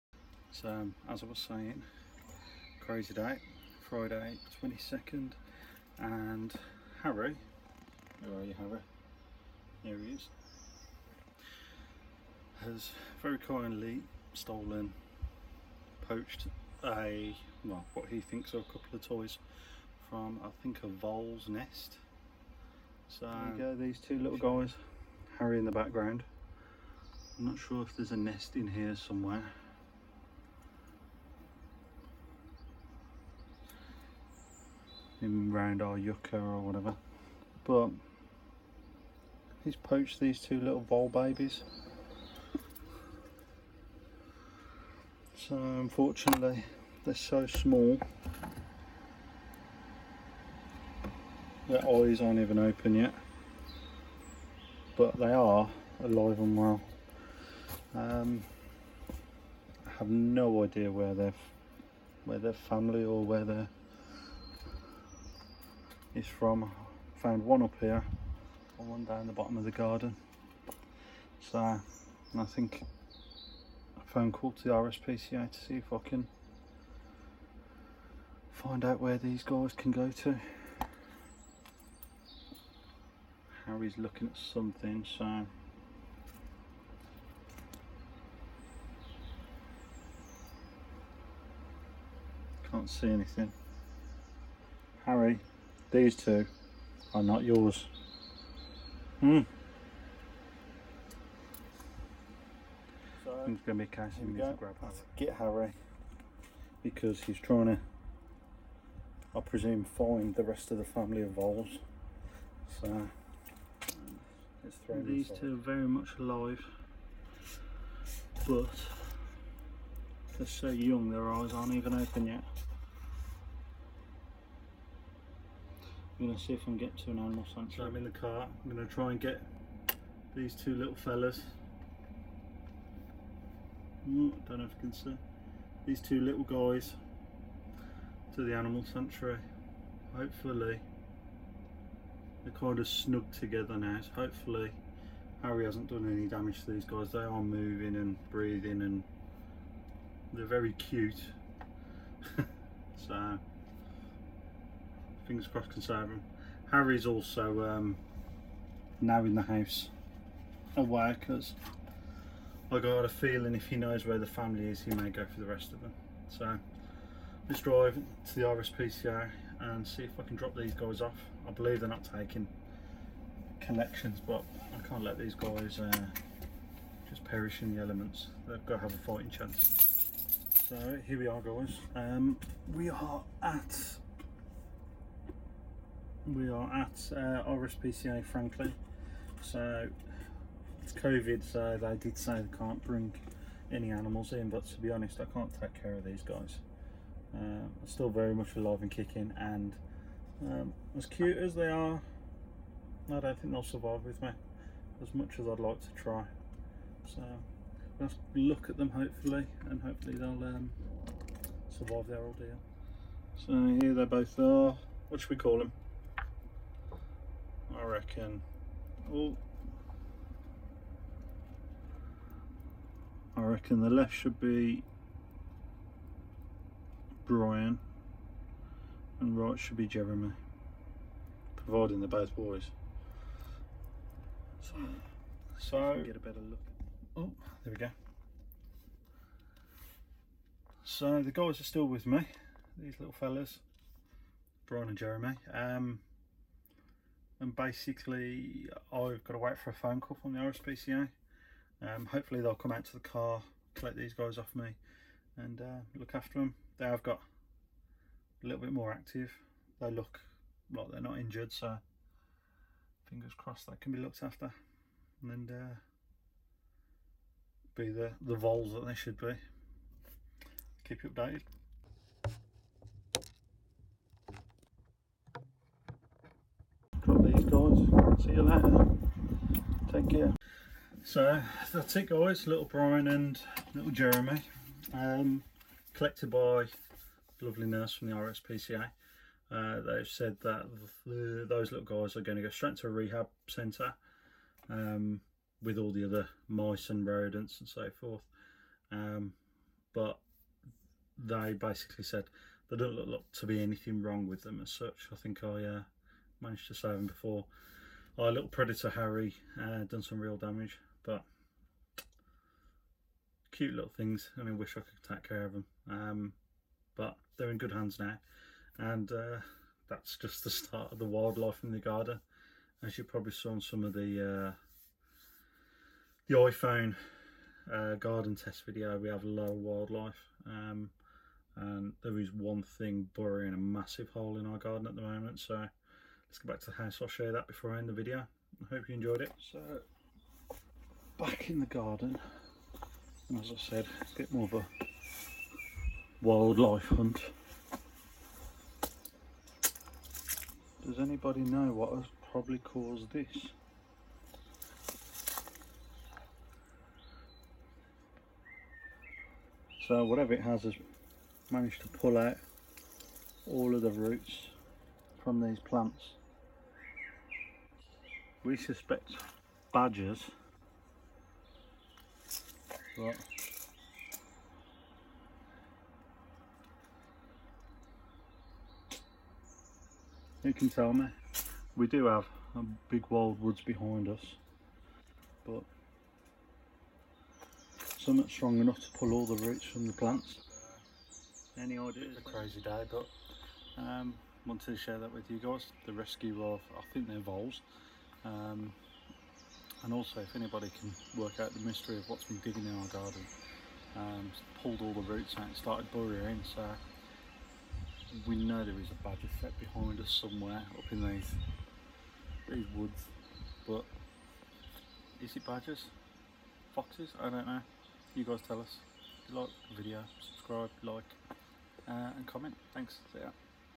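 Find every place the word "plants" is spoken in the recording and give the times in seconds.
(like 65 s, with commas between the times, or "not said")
365 s, 389 s.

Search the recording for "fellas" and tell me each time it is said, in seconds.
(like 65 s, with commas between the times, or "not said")
130 s, 243 s.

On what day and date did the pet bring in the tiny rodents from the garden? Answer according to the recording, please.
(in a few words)
Friday 22nd.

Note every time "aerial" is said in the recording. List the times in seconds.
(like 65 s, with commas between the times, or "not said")
not said.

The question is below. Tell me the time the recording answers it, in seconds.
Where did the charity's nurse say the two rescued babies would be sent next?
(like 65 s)
292 s.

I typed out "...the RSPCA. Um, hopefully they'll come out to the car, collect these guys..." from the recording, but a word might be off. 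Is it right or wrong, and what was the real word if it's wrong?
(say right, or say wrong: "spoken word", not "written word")
right.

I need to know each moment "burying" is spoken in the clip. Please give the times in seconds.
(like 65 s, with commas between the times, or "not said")
333 s, 405 s.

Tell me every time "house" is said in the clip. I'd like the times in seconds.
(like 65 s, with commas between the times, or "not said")
159 s, 336 s.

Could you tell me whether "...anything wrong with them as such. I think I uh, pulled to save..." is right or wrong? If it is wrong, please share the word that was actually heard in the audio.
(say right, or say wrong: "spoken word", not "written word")
wrong: "managed", not "pulled".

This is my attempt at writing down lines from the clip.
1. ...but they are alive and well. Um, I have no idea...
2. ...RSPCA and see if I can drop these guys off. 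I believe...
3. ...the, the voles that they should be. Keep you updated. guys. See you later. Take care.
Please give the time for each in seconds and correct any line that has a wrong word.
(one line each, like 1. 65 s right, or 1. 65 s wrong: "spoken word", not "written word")
1. 54 s right
2. 168 s right
3. 267 s right.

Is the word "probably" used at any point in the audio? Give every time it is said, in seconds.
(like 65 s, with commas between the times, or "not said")
323 s, 352 s.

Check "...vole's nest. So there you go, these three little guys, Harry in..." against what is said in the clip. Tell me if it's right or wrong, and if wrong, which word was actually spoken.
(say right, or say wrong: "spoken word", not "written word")
wrong: "two", not "three".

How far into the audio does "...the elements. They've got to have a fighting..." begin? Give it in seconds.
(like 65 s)
177 s.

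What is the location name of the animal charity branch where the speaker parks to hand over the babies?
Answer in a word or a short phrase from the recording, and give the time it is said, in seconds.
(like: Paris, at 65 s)
Franklin, at 188 s.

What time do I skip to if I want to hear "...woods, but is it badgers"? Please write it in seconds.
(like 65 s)
412 s.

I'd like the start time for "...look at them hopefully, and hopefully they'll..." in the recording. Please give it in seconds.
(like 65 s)
208 s.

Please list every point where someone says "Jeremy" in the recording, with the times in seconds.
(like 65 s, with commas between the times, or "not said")
229 s, 244 s, 283 s.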